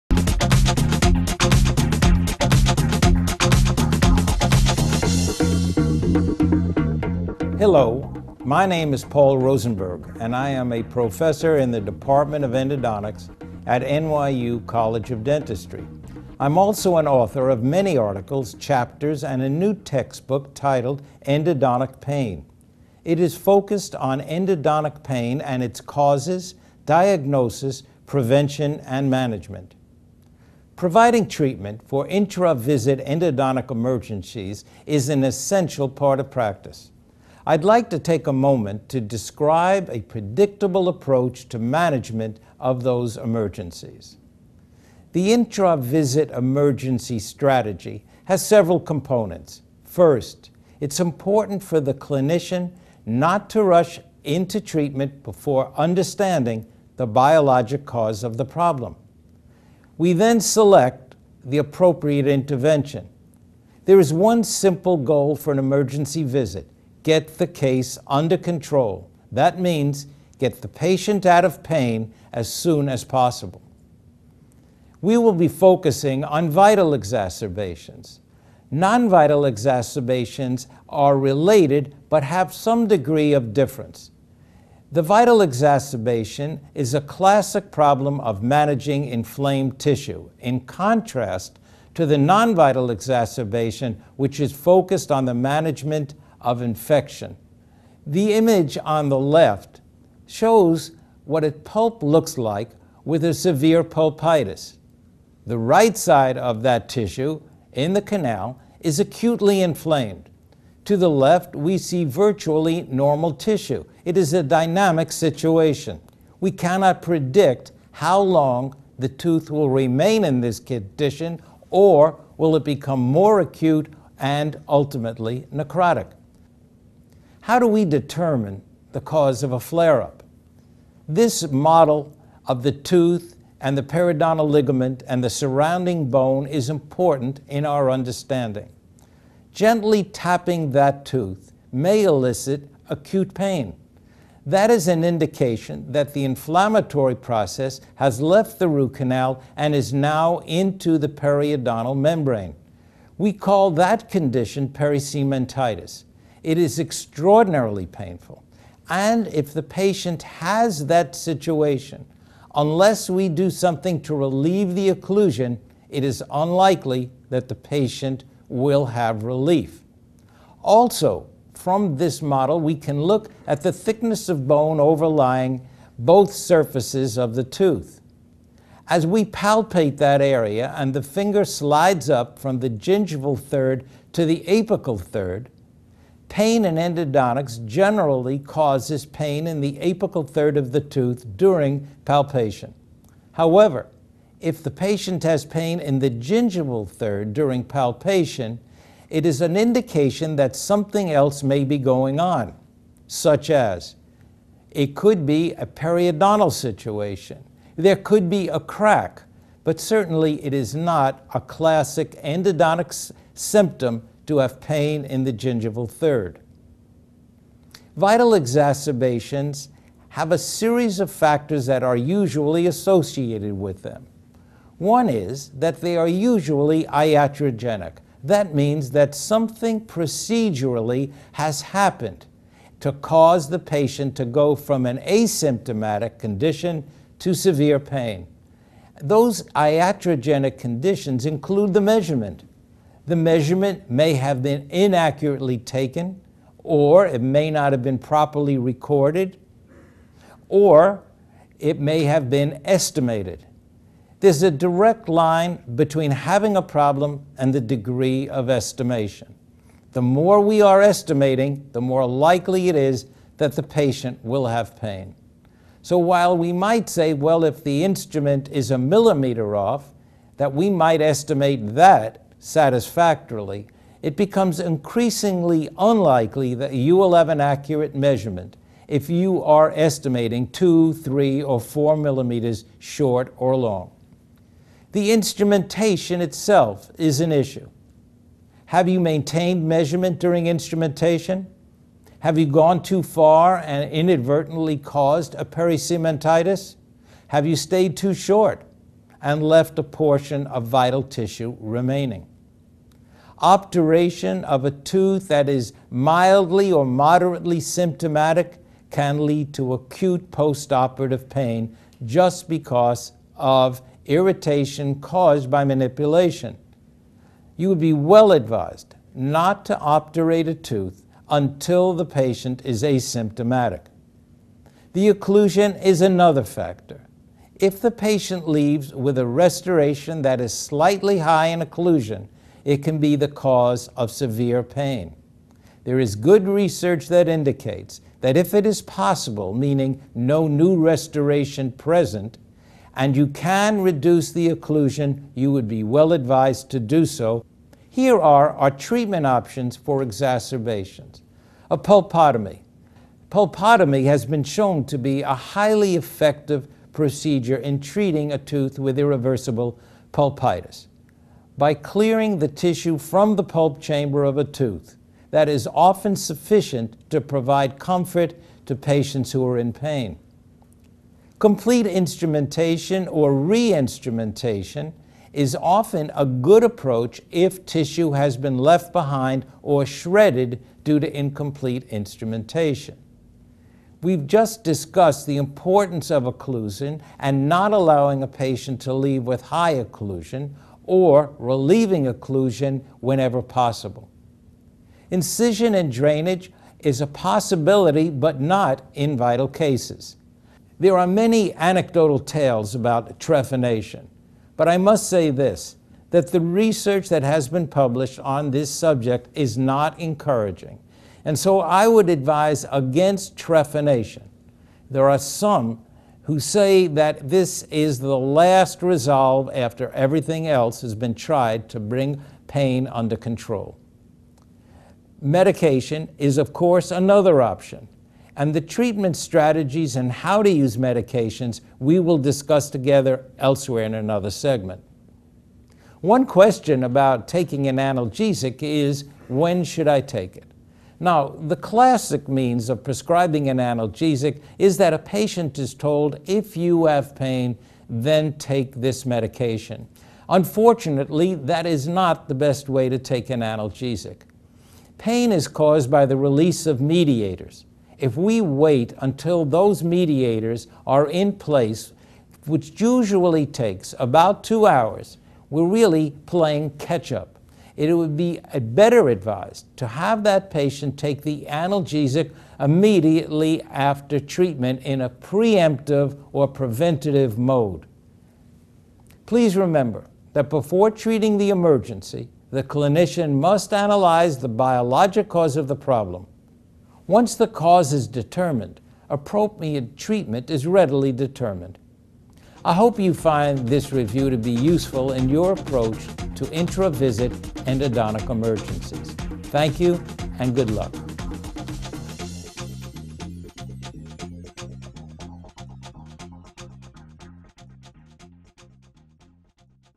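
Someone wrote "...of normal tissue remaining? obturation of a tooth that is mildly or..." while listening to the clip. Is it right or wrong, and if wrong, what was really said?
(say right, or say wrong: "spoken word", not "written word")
wrong: "vital", not "normal".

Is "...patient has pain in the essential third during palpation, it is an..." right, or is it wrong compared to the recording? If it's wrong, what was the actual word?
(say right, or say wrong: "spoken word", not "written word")
wrong: "gingival", not "essential".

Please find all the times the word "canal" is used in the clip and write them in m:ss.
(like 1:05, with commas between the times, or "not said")
1:48, 2:28.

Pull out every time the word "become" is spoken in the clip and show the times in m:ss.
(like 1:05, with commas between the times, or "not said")
2:02, 4:34.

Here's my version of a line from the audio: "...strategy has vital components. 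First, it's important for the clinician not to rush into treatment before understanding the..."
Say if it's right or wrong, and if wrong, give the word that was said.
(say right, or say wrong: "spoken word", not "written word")
wrong: "several", not "vital".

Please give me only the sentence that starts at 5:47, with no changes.
Here are our treatment options for exacerbations.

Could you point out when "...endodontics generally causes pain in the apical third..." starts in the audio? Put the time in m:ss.
3:06.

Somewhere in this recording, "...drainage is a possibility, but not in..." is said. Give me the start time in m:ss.
6:35.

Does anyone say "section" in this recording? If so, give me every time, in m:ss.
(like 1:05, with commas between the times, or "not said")
not said.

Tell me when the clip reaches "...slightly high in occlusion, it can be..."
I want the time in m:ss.
5:30.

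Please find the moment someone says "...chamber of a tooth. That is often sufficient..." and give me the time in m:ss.
6:03.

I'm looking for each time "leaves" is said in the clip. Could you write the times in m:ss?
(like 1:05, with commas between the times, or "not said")
5:28, 6:28.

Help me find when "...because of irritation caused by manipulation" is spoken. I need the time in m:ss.
5:12.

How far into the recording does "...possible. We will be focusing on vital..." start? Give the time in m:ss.
1:13.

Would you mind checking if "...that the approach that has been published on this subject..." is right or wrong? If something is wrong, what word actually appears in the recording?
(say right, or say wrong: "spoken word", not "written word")
wrong: "research", not "approach".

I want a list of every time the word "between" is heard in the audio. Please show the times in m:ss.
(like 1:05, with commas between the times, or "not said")
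4:15.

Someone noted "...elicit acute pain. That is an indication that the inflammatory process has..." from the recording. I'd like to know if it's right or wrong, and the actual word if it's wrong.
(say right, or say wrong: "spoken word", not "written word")
right.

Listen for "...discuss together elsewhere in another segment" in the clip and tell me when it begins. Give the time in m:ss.
7:12.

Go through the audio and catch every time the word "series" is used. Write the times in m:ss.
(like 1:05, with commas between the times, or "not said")
3:40.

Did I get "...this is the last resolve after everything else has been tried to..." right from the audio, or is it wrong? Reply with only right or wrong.
right.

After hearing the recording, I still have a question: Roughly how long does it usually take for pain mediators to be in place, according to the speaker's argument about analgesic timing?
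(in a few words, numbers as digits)
about 2 hours.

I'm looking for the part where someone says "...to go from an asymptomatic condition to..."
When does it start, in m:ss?
3:54.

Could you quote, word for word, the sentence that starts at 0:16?
I'm also an author of many articles, chapters, and a new textbook titled Endodontic Pain.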